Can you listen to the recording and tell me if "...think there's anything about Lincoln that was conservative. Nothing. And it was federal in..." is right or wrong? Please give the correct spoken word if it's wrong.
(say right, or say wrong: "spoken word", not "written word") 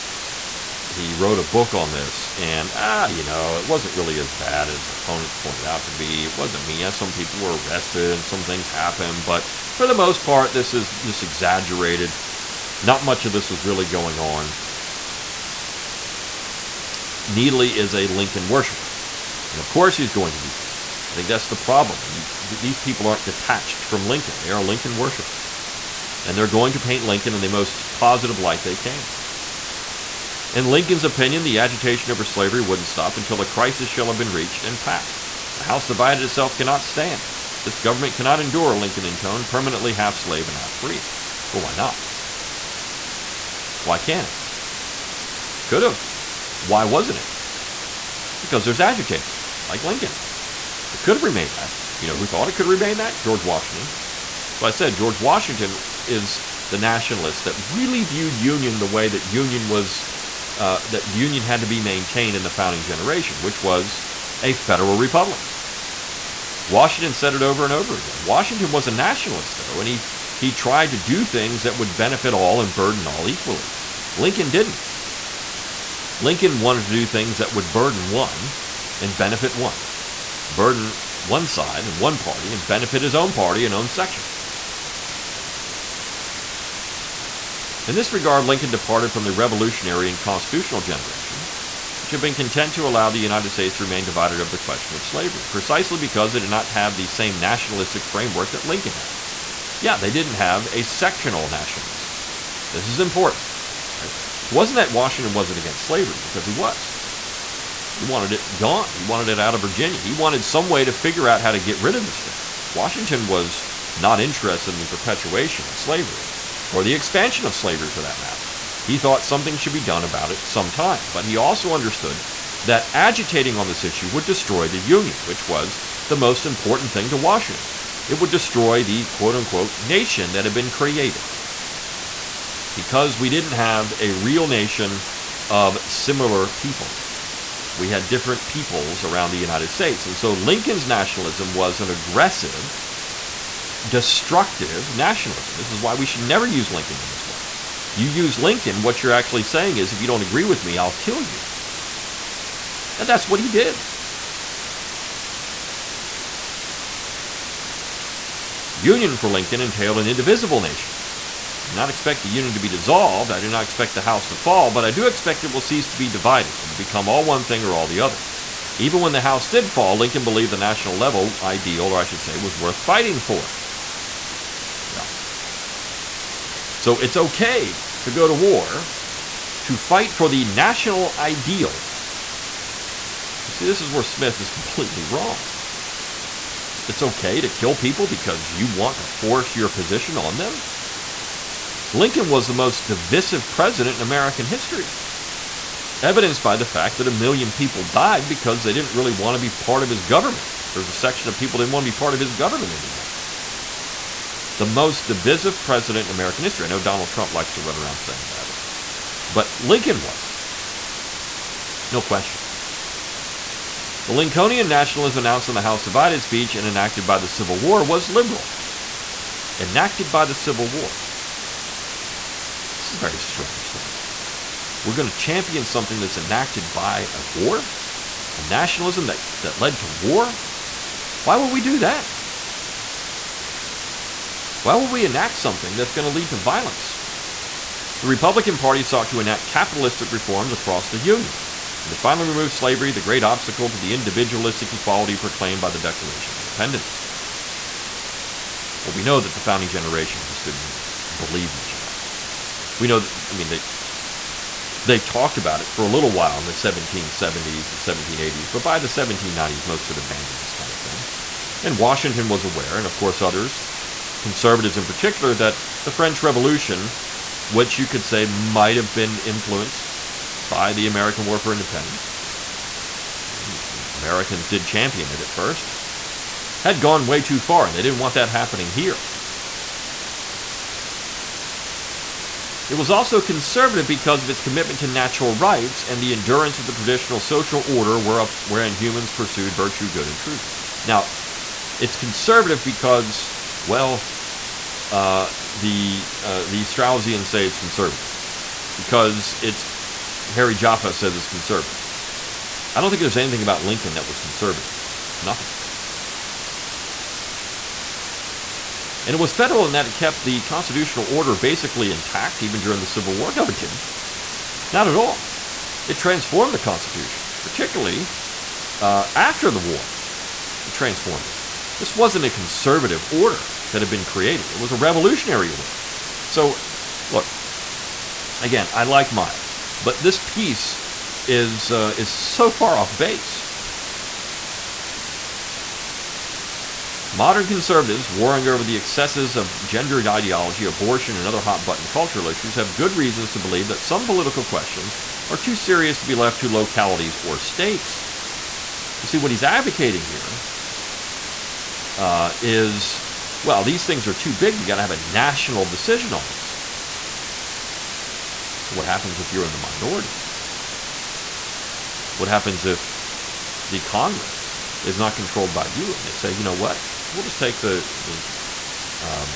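right.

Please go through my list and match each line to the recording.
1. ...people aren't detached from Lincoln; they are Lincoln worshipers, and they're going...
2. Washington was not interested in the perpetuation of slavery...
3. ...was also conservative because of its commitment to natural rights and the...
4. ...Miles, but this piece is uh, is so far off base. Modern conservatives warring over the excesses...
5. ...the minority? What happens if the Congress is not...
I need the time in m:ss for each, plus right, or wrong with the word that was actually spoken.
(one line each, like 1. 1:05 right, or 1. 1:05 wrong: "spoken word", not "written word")
1. 0:22 right
2. 1:52 right
3. 4:42 right
4. 5:29 right
5. 5:59 right.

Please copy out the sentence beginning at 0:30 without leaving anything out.
In Lincoln's opinion, the agitation over slavery wouldn't stop until a crisis shall have been reached and passed.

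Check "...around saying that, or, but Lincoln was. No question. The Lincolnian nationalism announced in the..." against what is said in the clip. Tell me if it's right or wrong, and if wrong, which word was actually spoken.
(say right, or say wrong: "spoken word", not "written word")
right.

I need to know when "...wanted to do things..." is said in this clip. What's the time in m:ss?
1:16.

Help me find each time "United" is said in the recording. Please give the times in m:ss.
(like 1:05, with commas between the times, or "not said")
1:33, 2:19.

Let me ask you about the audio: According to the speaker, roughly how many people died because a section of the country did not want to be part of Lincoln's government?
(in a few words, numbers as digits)
a million.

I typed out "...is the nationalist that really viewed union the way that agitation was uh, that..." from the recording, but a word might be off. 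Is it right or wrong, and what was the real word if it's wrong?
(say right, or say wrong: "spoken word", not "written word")
wrong: "union", not "agitation".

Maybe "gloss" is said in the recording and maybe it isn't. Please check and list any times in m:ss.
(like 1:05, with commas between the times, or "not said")
not said.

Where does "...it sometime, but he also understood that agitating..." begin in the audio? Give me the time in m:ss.
2:00.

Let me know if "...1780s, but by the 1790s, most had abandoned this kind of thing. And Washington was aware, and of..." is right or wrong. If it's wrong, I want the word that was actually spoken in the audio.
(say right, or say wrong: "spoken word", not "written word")
right.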